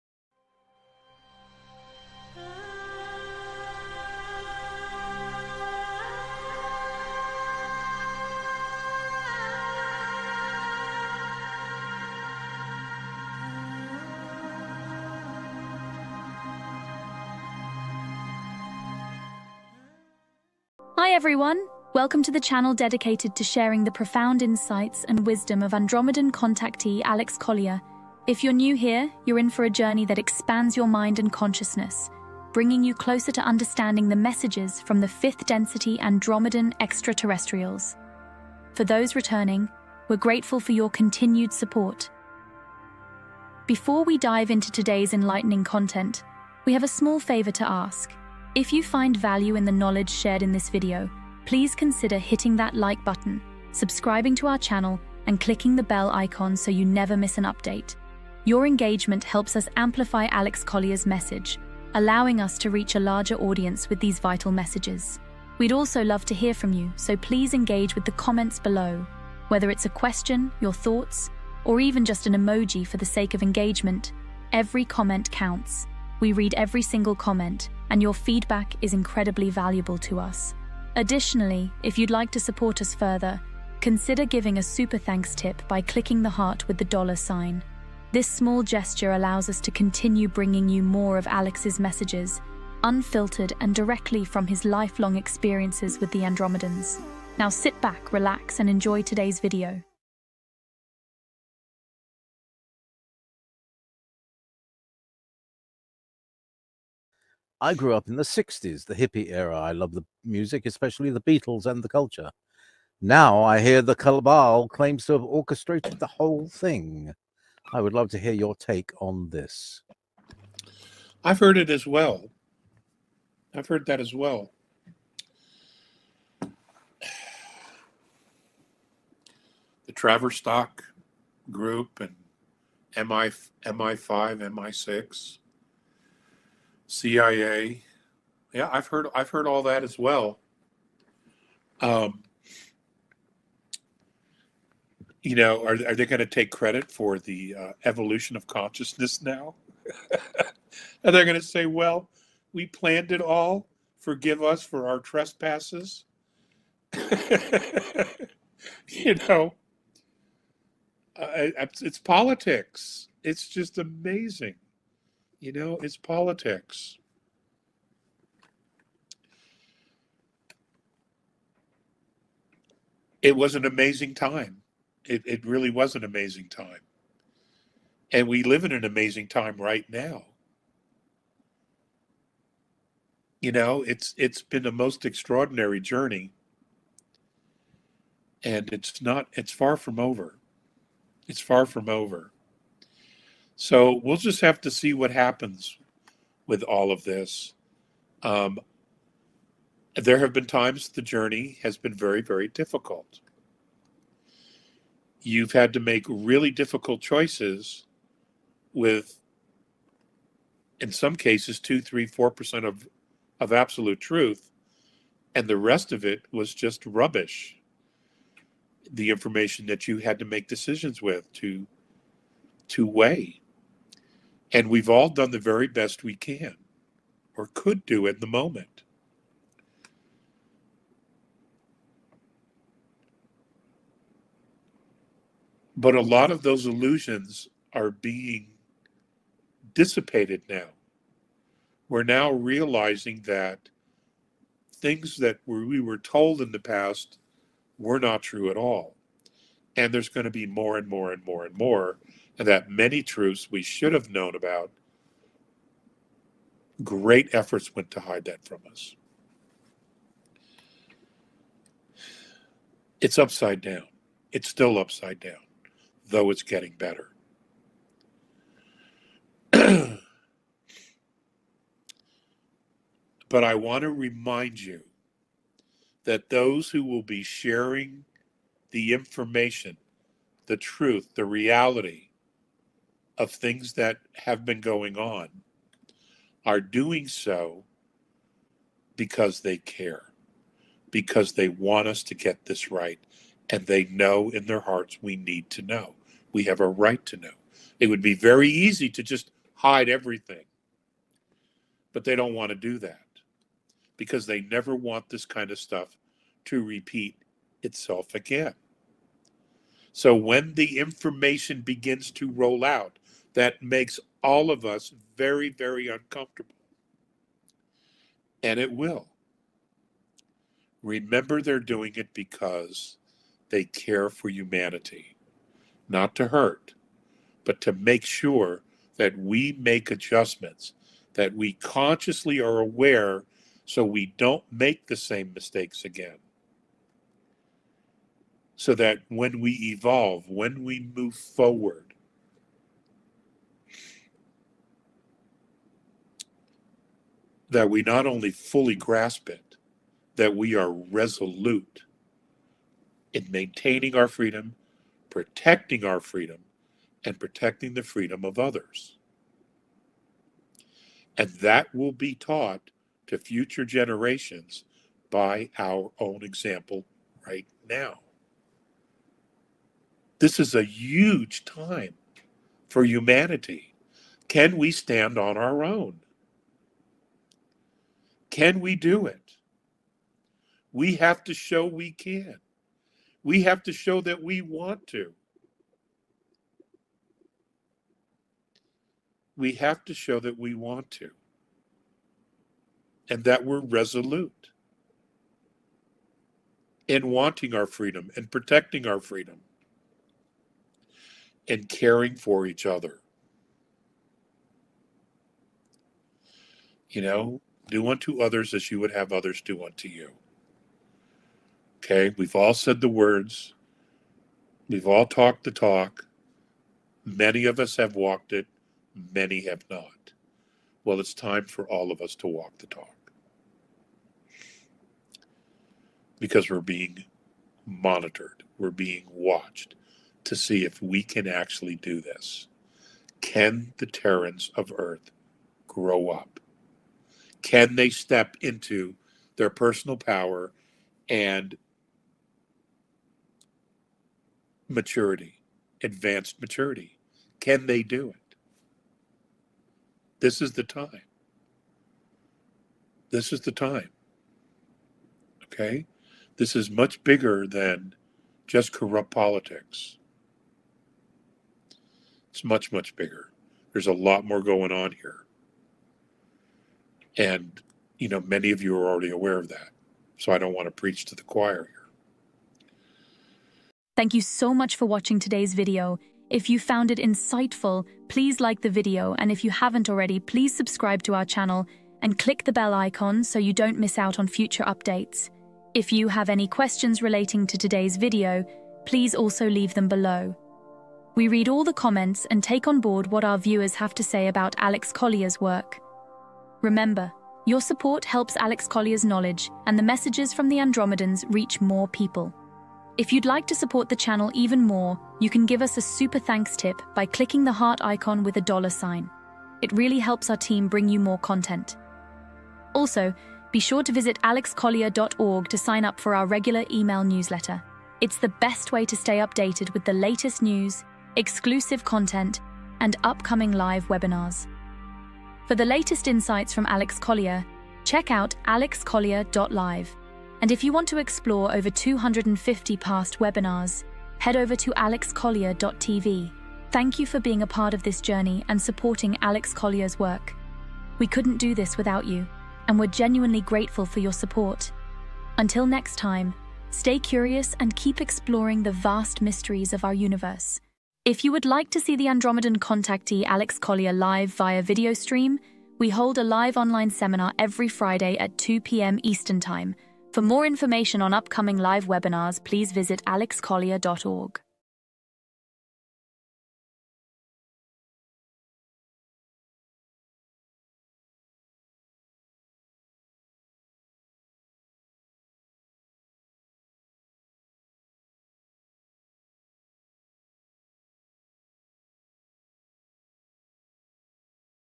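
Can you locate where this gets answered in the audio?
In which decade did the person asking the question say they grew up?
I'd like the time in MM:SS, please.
01:48.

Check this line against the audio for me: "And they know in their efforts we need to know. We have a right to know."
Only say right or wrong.
wrong.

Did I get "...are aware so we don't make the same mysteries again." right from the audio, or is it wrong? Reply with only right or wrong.
wrong.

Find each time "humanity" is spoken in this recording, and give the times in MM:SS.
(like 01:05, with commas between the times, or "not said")
05:24, 06:12.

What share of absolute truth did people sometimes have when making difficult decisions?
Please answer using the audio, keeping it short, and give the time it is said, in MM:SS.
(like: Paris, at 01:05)
2 to 4 percent, at 03:31.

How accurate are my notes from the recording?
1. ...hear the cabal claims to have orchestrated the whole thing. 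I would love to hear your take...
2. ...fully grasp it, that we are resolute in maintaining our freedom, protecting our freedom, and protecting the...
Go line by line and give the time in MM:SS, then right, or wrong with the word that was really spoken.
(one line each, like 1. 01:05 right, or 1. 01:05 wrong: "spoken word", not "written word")
1. 01:53 right
2. 05:48 right.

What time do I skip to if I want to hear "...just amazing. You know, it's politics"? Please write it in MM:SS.
02:43.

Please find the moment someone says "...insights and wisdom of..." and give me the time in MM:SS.
00:24.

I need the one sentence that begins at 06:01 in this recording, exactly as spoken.
And that will be taught to future generations by our own example right now.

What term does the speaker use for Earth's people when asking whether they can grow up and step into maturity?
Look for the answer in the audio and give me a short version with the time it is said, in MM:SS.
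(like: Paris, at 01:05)
Terrans, at 07:13.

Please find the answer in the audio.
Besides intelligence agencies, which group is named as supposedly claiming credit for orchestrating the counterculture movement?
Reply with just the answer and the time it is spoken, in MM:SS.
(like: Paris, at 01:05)
Tavistock group, at 02:09.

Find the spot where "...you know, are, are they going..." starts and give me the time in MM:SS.
02:25.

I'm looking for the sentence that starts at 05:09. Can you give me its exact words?
So when the information begins to roll out, that makes all of us very, very uncomfortable.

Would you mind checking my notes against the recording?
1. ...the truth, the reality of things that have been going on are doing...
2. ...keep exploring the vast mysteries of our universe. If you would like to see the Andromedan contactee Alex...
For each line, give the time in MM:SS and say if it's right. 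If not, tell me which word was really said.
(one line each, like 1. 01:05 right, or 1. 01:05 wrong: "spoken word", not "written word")
1. 04:40 right
2. 09:07 right.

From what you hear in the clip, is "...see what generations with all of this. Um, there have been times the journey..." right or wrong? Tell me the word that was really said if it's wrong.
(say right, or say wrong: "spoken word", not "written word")
wrong: "happens", not "generations".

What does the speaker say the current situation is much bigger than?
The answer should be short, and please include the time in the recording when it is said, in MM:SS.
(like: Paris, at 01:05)
corrupt politics, at 07:38.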